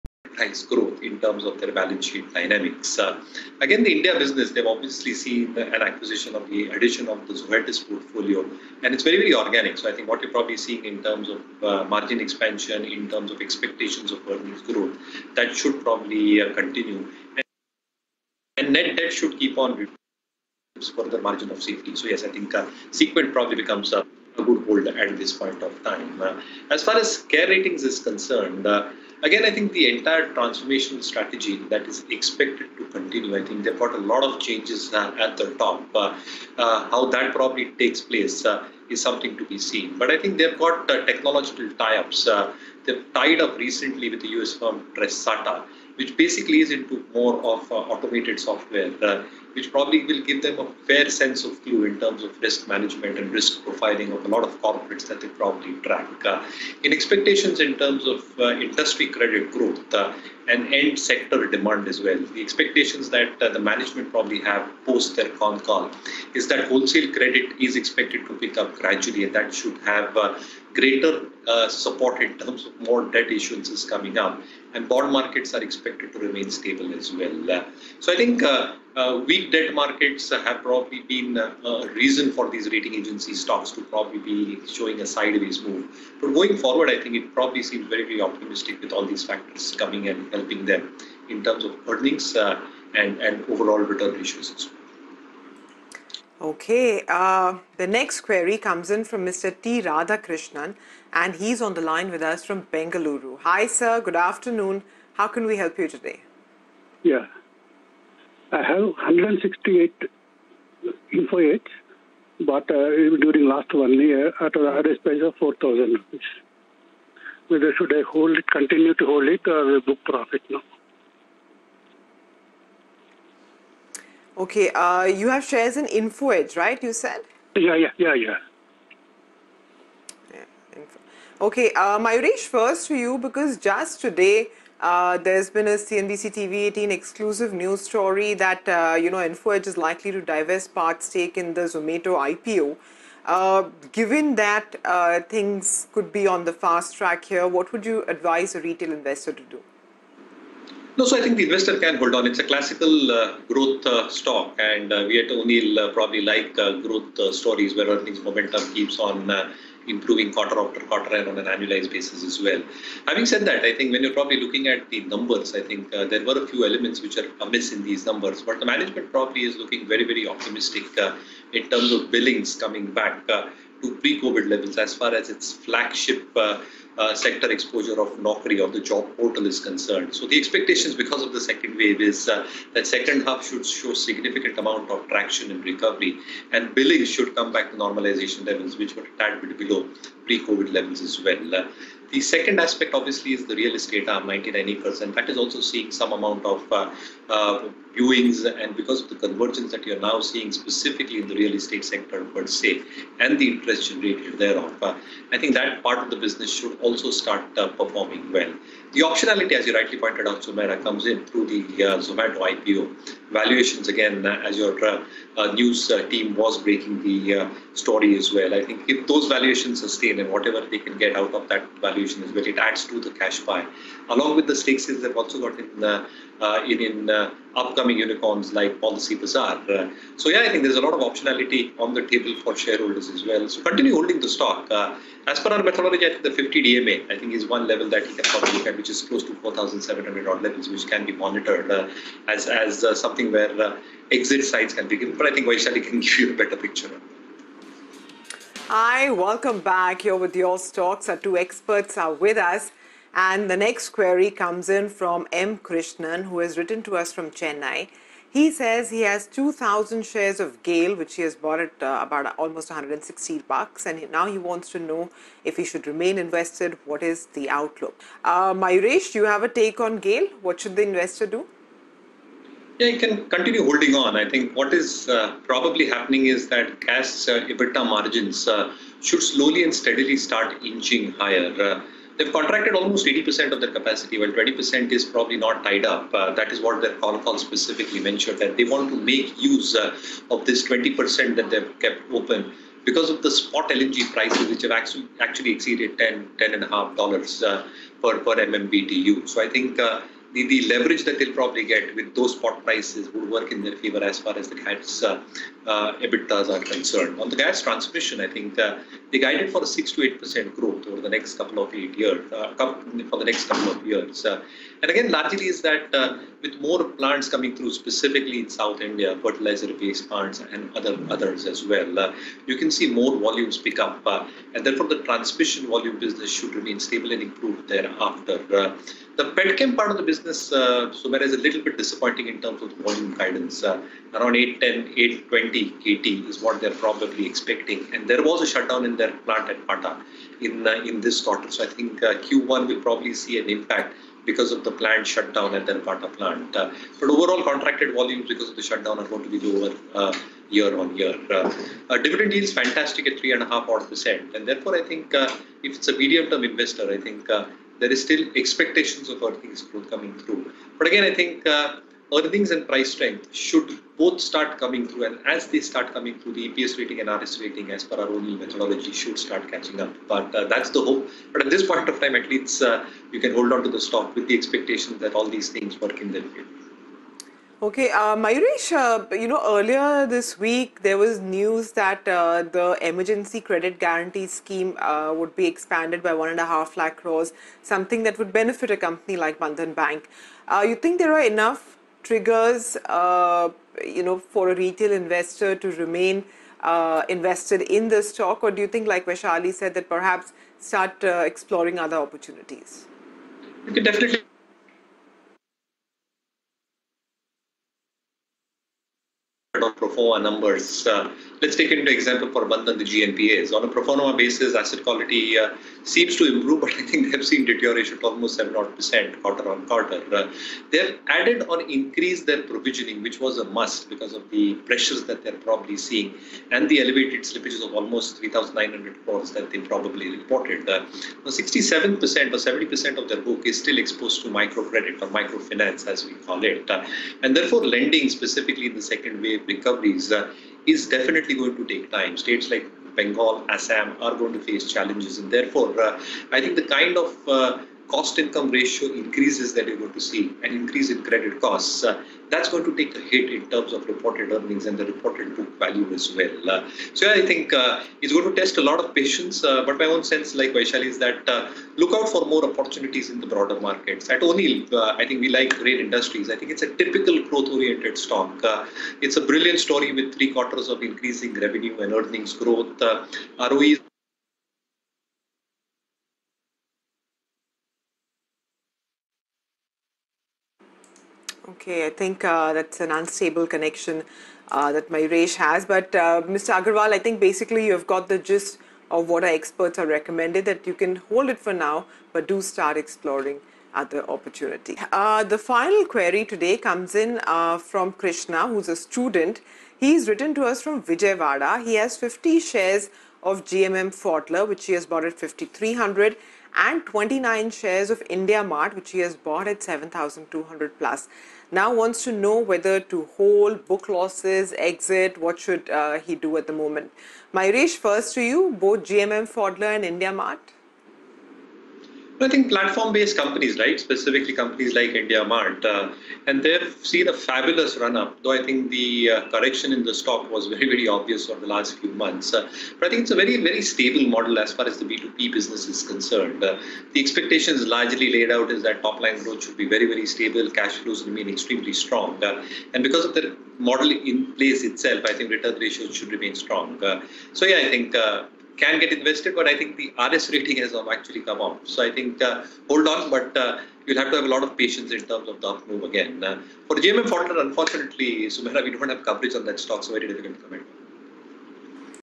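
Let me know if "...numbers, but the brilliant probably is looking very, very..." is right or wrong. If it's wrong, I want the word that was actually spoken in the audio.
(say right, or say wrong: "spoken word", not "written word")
wrong: "management", not "brilliant".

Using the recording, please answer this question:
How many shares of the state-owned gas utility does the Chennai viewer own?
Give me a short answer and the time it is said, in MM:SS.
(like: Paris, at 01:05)
2,000, at 04:19.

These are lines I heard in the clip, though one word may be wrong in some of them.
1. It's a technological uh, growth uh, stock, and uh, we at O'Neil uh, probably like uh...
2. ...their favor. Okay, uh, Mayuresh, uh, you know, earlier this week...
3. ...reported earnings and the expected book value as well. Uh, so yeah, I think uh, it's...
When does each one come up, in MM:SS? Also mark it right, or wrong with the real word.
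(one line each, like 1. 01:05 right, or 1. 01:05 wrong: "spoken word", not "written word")
1. 02:32 wrong: "classical", not "technological"
2. 06:16 right
3. 07:33 wrong: "reported", not "expected".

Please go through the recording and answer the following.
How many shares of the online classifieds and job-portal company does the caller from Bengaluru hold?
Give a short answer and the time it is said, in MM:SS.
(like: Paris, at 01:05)
168, at 01:48.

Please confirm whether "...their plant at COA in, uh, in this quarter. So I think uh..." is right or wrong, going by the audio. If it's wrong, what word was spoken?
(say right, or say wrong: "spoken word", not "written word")
wrong: "Pata", not "COA".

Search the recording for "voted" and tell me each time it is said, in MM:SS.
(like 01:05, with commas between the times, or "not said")
not said.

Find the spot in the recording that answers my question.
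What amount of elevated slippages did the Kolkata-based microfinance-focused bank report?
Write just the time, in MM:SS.
07:08.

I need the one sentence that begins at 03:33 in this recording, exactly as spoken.
Valuations, again, uh, as your uh, uh news uh, team was breaking the story as well.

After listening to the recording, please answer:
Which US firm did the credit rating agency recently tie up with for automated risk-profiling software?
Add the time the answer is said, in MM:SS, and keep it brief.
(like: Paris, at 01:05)
Tresata, at 00:44.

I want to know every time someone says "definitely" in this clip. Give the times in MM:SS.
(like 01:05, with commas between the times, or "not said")
06:43, 07:20.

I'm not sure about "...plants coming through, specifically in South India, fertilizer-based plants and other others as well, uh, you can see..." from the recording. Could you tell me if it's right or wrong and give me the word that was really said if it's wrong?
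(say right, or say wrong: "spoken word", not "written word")
right.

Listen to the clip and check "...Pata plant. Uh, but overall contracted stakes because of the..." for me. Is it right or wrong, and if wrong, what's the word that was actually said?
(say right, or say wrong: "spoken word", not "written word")
wrong: "volumes", not "stakes".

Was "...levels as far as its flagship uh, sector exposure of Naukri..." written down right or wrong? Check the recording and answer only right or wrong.
right.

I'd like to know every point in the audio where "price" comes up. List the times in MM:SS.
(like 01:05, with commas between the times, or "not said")
01:55, 04:54, 05:02, 06:02.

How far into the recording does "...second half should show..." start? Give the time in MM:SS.
03:02.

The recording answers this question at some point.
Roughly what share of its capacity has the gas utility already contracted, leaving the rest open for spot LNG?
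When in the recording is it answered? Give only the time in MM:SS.
04:43.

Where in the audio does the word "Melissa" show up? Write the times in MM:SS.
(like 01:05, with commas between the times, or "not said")
not said.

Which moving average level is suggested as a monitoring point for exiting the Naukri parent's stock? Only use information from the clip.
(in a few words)
50 DMA.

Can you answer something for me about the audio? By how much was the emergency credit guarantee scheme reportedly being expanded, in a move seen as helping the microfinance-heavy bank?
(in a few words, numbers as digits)
1.5 lakh crores.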